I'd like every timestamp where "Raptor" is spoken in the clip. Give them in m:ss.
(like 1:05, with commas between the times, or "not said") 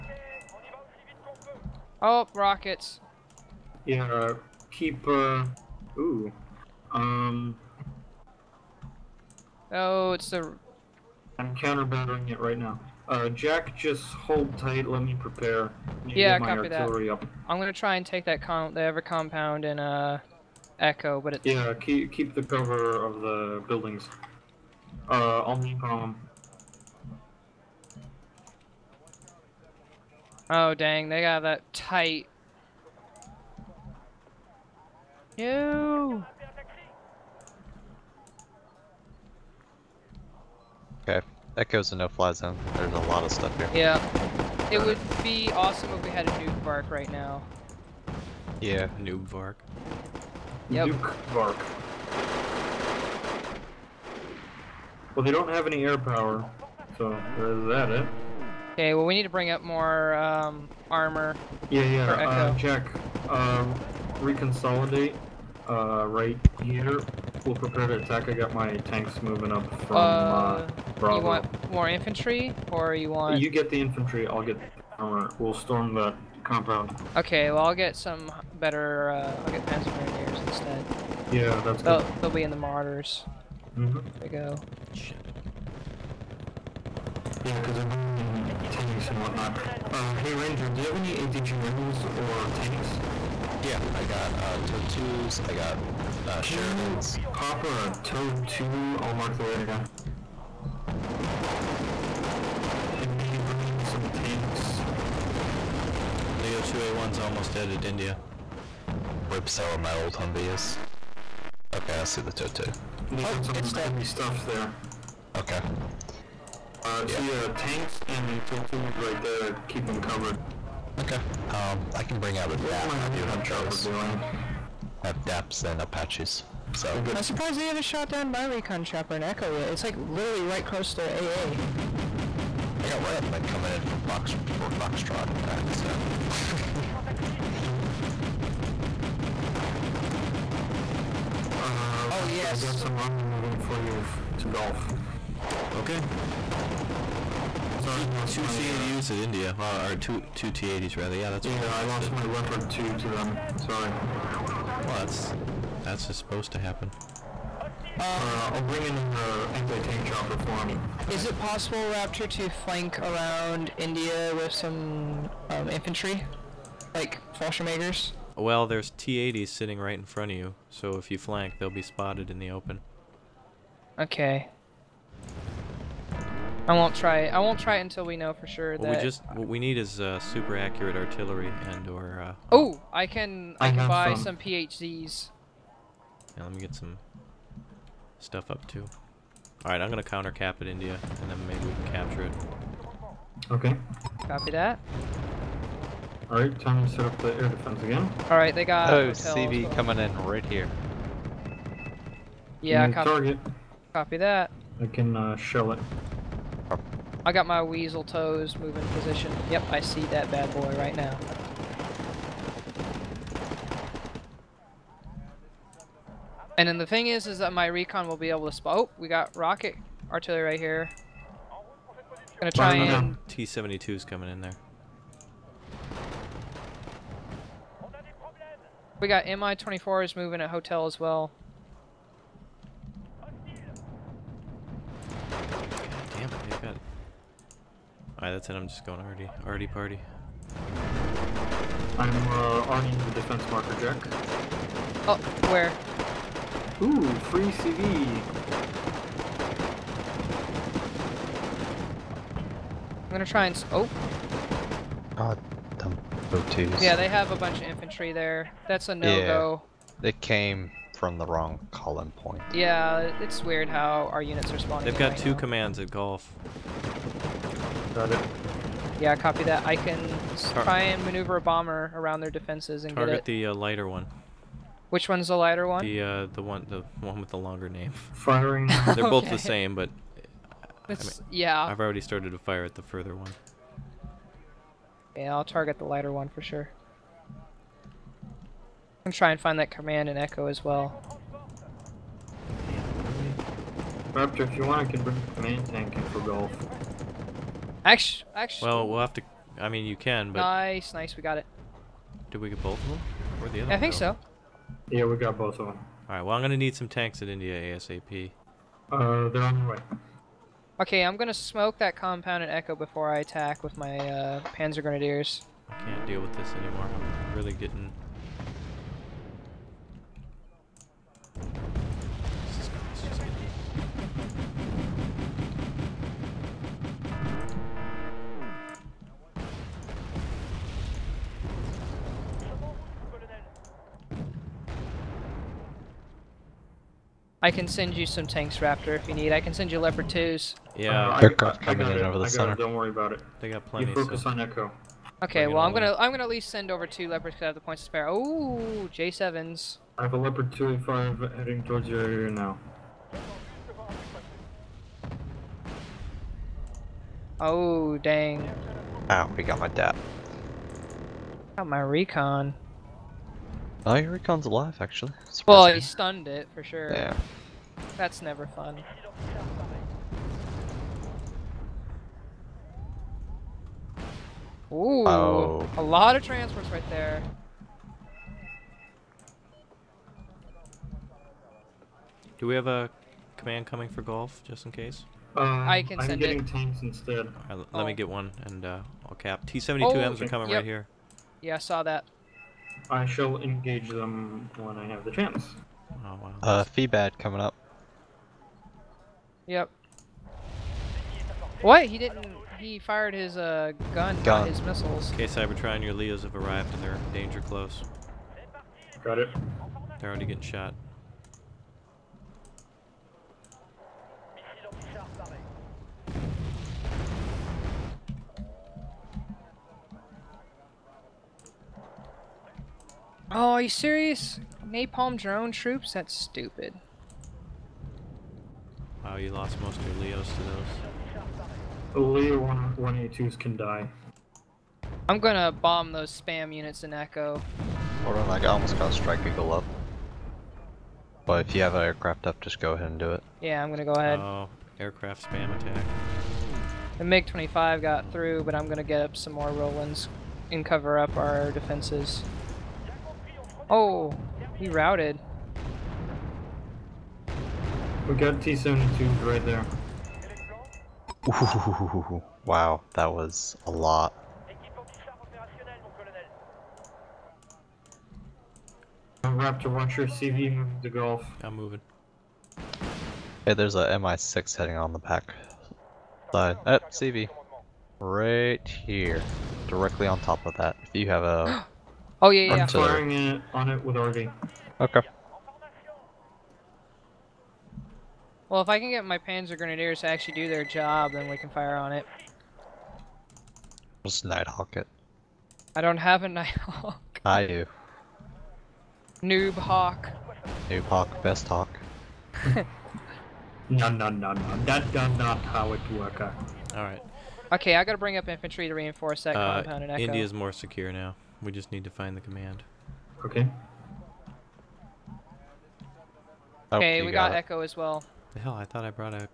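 2:22, 2:41, 4:54, 5:38, 7:49.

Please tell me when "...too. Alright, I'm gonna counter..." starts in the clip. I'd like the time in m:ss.
3:08.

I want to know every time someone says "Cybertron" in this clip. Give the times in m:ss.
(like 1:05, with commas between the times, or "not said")
6:45.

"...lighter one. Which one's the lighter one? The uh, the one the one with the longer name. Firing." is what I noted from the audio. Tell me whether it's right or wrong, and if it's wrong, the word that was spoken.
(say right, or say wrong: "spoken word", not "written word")
right.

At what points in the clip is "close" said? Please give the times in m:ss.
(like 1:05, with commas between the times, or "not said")
2:10, 6:47.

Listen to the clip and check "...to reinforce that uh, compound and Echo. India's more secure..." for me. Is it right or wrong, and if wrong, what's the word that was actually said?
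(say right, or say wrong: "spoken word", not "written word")
right.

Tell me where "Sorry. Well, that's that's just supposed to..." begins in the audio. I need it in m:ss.
2:33.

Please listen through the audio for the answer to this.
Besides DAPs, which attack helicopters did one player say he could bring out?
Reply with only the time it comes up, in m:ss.
2:05.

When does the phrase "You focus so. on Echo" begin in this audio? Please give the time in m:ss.
5:43.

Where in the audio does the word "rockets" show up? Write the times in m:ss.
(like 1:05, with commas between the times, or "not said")
0:02, 3:39.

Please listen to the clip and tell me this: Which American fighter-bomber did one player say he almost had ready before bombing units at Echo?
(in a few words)
Strike Eagle.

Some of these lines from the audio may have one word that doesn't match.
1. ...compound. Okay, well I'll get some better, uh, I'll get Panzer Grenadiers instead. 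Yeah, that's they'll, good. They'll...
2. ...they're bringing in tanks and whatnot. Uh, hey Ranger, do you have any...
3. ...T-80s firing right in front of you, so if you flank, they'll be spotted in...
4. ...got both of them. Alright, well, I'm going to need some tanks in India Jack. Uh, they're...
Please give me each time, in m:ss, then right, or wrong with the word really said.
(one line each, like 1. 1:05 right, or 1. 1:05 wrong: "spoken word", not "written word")
1. 1:16 right
2. 1:27 right
3. 2:48 wrong: "sitting", not "firing"
4. 5:05 wrong: "ASAP", not "Jack".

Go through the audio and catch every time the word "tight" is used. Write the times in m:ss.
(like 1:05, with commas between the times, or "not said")
0:14, 0:31.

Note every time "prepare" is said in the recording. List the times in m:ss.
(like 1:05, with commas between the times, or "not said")
0:15, 1:07.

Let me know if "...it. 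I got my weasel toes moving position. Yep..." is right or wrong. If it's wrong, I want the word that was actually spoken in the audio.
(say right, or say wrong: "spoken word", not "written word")
right.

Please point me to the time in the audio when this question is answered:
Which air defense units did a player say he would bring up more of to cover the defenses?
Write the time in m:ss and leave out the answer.
7:29.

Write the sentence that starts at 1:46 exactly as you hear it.
Leo 2A1's almost dead at India.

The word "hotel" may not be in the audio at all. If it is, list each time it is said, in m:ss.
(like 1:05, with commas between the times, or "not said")
3:50.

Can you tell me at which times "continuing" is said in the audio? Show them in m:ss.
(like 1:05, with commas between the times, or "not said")
not said.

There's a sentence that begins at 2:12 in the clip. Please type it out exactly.
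I got riflemen coming in from Fox for Foxtrot attack, so.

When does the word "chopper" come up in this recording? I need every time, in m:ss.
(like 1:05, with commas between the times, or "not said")
2:08, 2:40.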